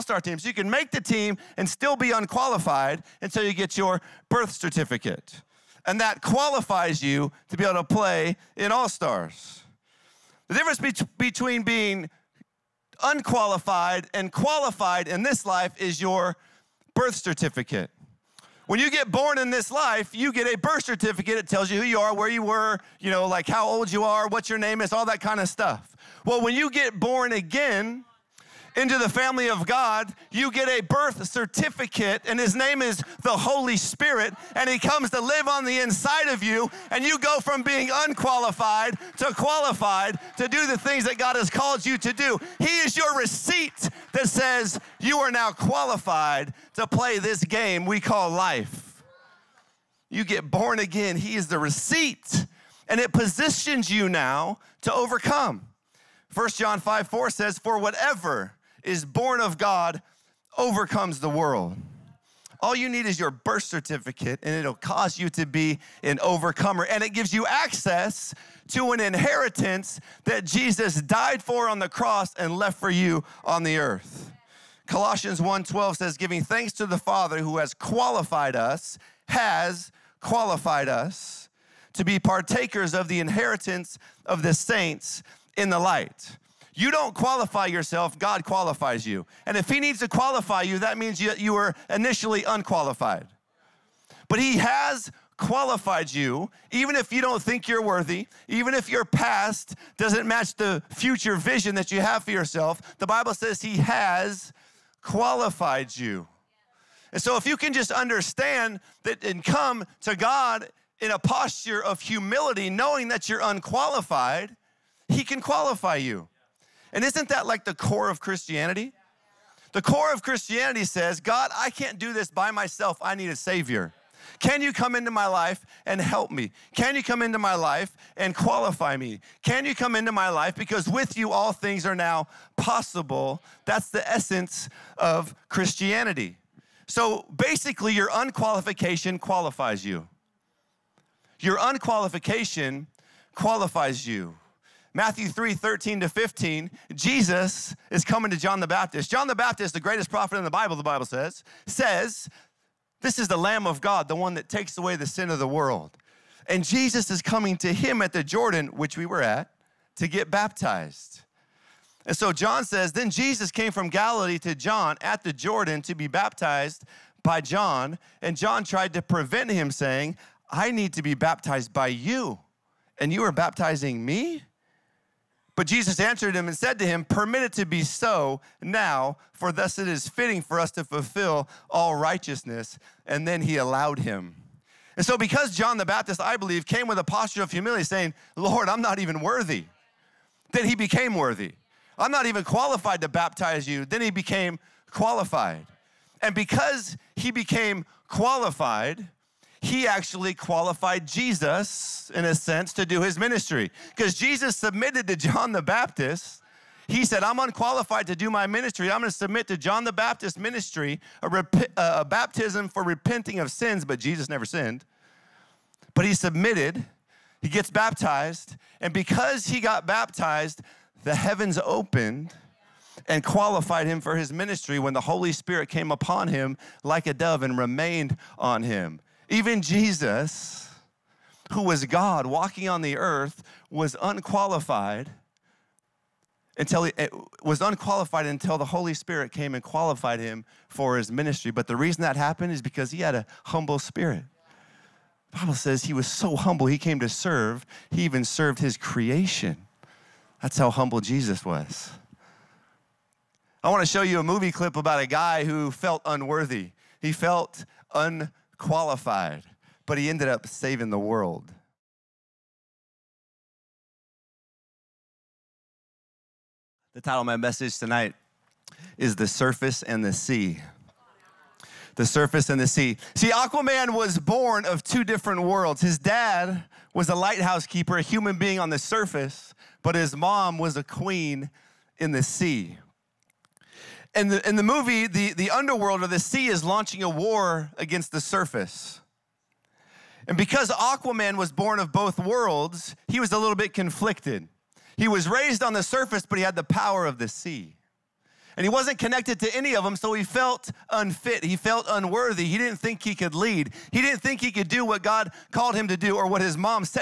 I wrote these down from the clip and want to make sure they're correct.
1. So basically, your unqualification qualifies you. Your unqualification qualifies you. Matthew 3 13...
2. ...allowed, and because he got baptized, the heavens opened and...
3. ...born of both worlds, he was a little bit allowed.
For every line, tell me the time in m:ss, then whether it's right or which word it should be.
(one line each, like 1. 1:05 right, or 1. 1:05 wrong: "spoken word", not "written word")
1. 2:16 right
2. 3:37 wrong: "baptized", not "allowed"
3. 4:51 wrong: "conflicted", not "allowed".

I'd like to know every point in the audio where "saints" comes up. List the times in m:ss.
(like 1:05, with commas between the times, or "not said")
1:24.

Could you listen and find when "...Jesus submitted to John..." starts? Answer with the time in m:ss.
3:24.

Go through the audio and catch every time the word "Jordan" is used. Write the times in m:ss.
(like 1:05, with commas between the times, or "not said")
2:38, 2:45.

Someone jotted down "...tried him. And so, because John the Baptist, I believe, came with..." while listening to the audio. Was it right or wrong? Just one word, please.
wrong.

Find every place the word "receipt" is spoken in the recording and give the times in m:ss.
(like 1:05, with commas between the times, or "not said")
0:43, 0:51.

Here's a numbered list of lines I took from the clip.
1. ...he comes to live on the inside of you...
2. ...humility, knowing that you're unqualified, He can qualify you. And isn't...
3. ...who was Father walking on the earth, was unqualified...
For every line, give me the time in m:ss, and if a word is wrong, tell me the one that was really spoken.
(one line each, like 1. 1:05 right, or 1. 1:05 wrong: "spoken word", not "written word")
1. 0:34 right
2. 1:52 right
3. 3:51 wrong: "God", not "Father".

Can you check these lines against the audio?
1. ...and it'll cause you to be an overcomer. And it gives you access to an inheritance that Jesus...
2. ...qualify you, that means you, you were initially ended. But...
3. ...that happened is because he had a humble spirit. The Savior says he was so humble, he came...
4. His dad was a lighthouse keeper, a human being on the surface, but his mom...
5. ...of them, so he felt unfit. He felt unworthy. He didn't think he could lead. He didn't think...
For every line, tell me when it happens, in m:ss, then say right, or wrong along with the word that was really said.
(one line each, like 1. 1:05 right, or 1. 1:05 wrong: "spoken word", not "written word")
1. 1:04 right
2. 1:30 wrong: "unqualified", not "ended"
3. 4:02 wrong: "Bible", not "Savior"
4. 4:35 right
5. 4:59 right.